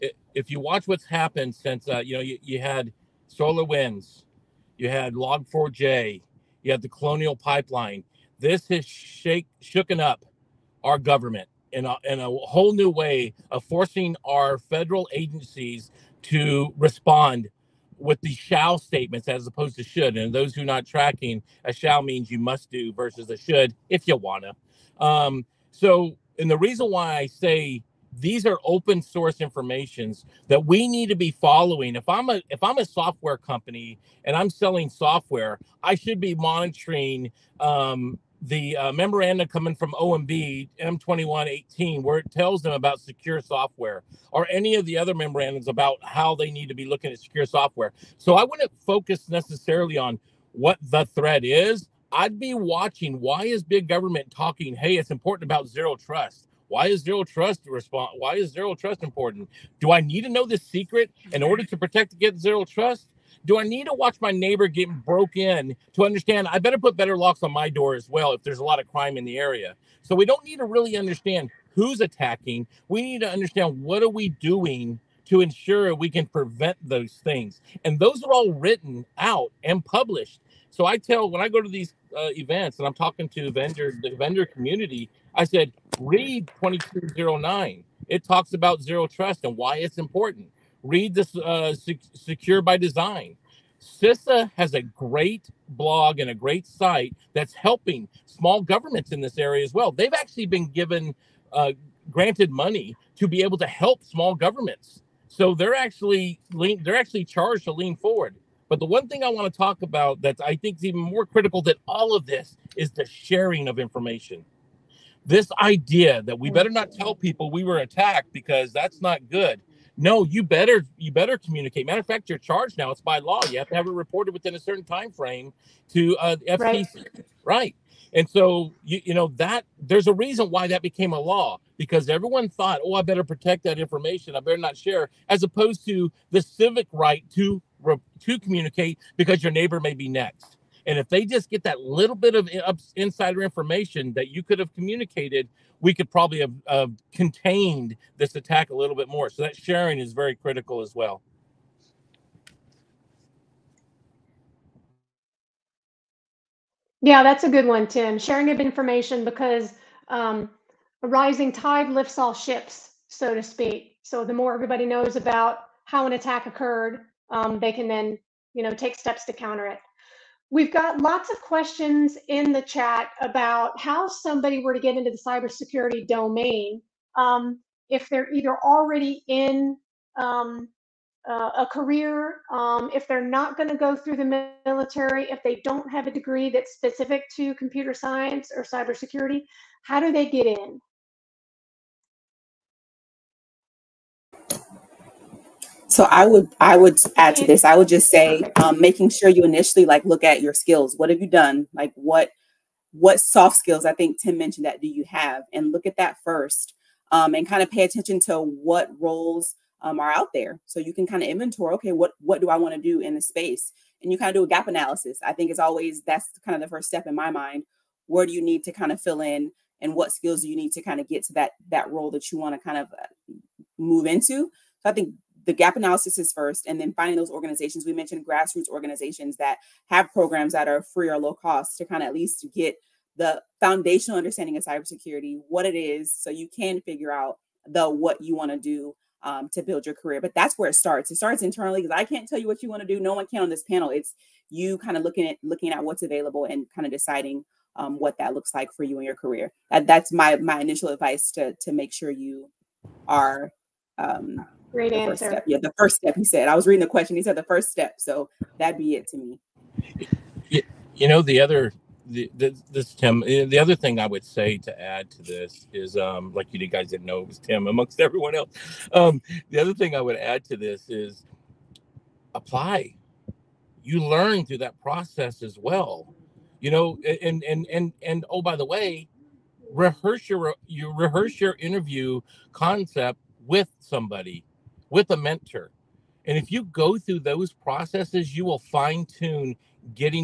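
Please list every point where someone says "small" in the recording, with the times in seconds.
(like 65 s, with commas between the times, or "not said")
98 s, 104 s.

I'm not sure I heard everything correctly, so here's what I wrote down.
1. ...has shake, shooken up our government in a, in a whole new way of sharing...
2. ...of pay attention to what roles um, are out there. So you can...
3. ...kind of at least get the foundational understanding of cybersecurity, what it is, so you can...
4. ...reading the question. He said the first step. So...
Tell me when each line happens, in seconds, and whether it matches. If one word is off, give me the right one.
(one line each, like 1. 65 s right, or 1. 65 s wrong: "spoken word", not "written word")
1. 8 s wrong: "forcing", not "sharing"
2. 207 s right
3. 231 s right
4. 256 s right.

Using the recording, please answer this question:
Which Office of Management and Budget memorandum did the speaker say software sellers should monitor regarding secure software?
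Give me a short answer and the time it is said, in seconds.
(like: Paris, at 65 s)
M2118, at 40 s.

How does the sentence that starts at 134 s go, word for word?
I better not share, as opposed to the civic right to to communicate because your neighbor may be next.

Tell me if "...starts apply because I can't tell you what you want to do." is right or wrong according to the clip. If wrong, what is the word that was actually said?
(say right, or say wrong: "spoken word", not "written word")
wrong: "internally", not "apply".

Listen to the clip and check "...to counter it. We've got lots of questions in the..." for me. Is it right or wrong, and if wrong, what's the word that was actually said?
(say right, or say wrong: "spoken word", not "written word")
right.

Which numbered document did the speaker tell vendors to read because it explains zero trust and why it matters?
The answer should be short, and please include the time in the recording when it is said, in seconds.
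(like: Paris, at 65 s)
2209, at 86 s.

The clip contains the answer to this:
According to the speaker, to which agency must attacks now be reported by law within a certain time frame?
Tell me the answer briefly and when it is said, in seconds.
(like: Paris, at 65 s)
FTC, at 126 s.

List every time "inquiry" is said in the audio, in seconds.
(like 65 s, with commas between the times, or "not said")
not said.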